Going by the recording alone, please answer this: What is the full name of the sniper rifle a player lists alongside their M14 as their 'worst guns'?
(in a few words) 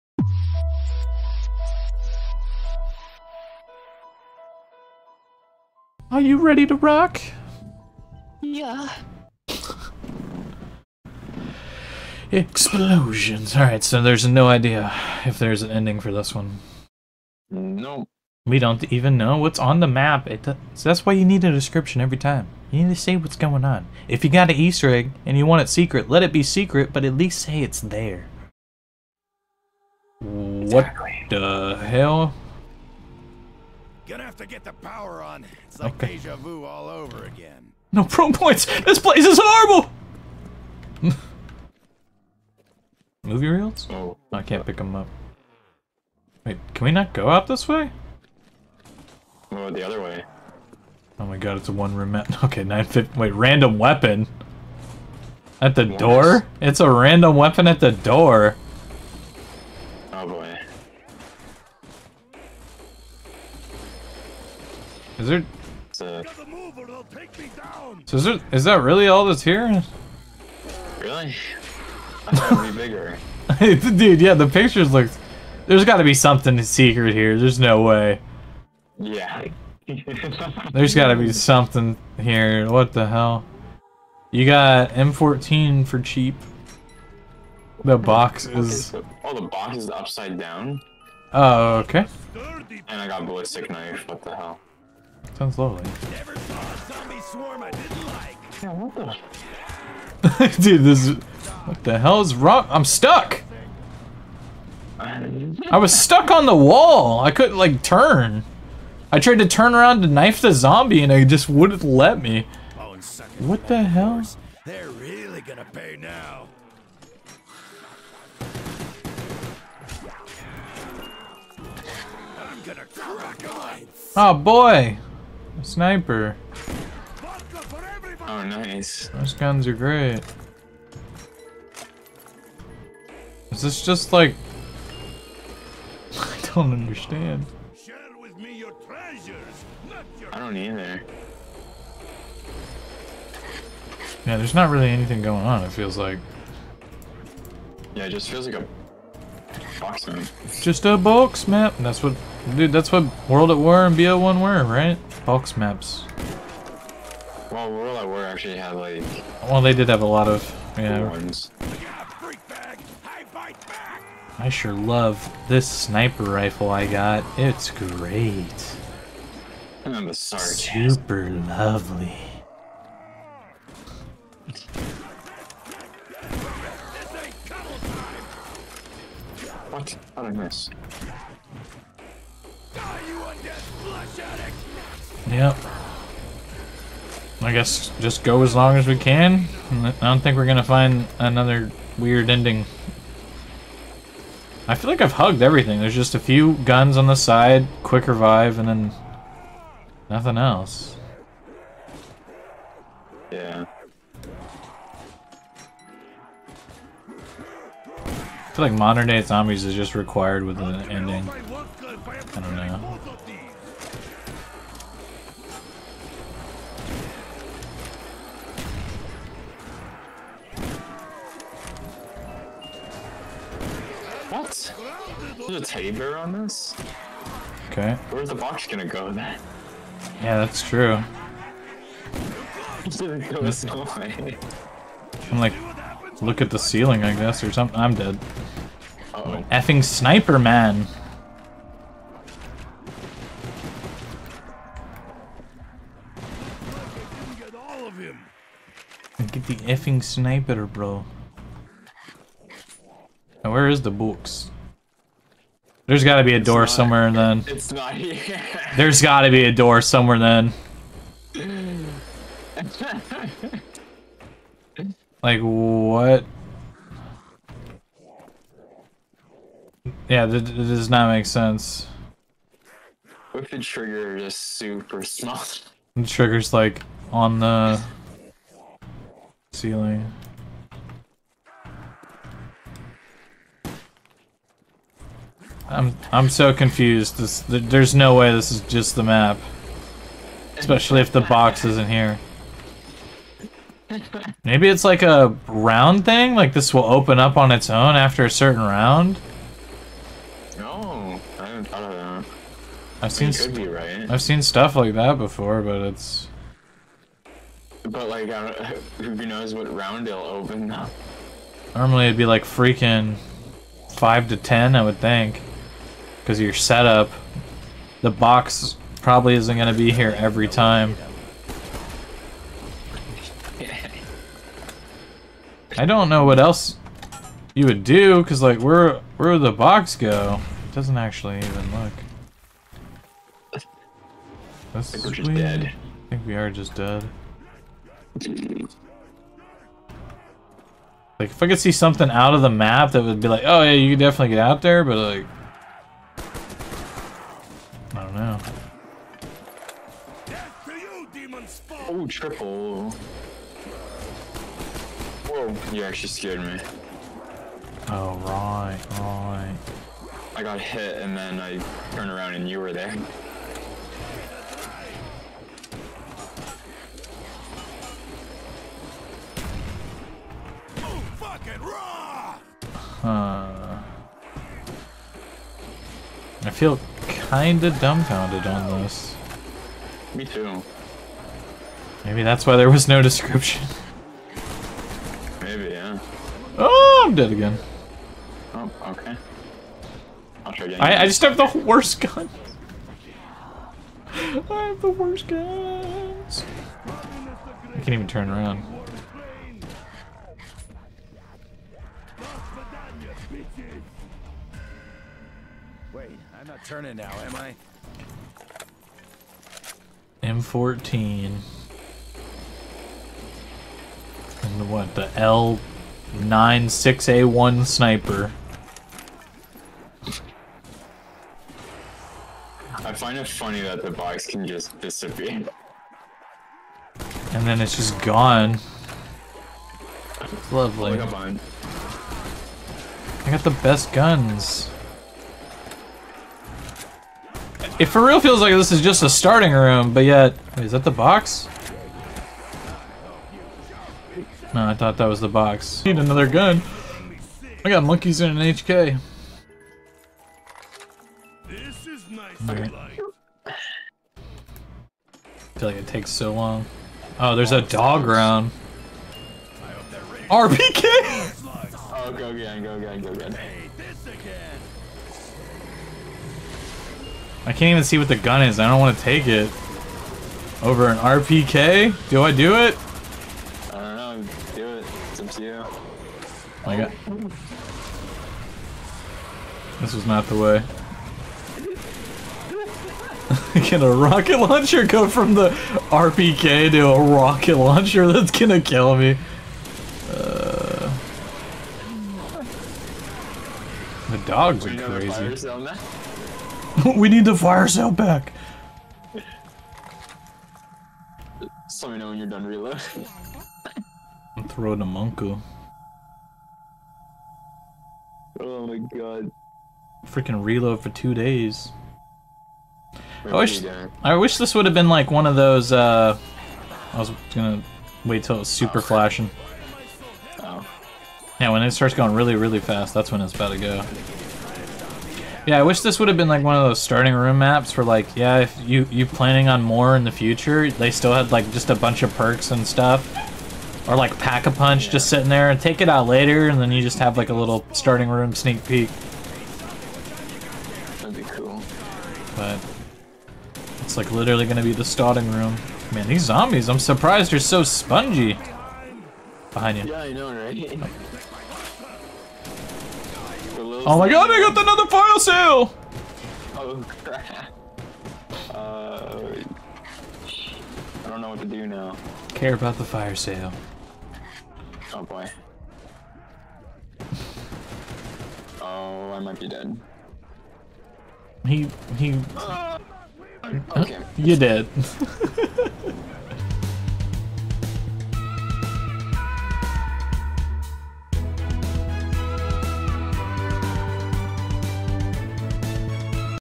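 L96A1.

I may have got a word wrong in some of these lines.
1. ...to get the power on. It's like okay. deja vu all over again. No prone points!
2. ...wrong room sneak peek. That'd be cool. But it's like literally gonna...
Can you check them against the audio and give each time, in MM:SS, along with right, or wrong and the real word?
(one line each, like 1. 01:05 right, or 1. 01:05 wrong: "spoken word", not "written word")
1. 00:34 right
2. 08:57 wrong: "starting", not "wrong".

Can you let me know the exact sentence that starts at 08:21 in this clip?
let me know when you're done reloading.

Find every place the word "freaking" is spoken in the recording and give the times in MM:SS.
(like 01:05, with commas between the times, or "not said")
05:12, 08:30.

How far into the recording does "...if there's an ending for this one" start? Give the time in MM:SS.
00:15.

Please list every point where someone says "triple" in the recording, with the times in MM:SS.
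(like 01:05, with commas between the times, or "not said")
05:52.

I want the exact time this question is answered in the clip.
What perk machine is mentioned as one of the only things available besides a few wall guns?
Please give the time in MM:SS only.
03:17.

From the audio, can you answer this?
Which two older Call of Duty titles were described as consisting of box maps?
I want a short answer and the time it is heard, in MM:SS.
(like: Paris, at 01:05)
World at War and BO1, at 02:33.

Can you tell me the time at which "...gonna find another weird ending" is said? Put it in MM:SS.
03:10.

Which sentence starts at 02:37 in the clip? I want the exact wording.
Well, World at War actually had like.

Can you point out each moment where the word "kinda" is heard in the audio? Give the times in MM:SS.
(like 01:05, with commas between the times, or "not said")
06:17.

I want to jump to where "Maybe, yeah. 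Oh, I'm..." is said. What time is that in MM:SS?
06:25.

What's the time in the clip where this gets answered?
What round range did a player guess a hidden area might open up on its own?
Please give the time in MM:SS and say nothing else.
05:13.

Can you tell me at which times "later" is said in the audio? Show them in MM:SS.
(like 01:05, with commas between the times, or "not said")
08:56.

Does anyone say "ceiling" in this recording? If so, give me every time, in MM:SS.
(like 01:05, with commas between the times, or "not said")
03:56, 04:39.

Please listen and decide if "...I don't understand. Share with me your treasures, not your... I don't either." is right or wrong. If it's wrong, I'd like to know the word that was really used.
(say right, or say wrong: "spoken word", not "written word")
right.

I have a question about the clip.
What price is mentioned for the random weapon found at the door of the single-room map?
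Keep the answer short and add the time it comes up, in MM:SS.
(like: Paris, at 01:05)
950, at 00:52.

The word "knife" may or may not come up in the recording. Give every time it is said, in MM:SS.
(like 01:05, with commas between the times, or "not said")
01:33, 01:50.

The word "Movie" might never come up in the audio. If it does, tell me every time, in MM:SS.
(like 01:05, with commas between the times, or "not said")
00:43.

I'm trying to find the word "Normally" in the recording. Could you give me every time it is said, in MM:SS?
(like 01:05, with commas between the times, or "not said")
05:11.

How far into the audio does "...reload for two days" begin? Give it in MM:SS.
08:30.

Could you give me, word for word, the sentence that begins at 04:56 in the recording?
Like this will open up on its own after a certain round?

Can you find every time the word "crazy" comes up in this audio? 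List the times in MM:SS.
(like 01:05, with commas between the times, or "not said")
08:14.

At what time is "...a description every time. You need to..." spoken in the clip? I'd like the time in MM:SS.
00:21.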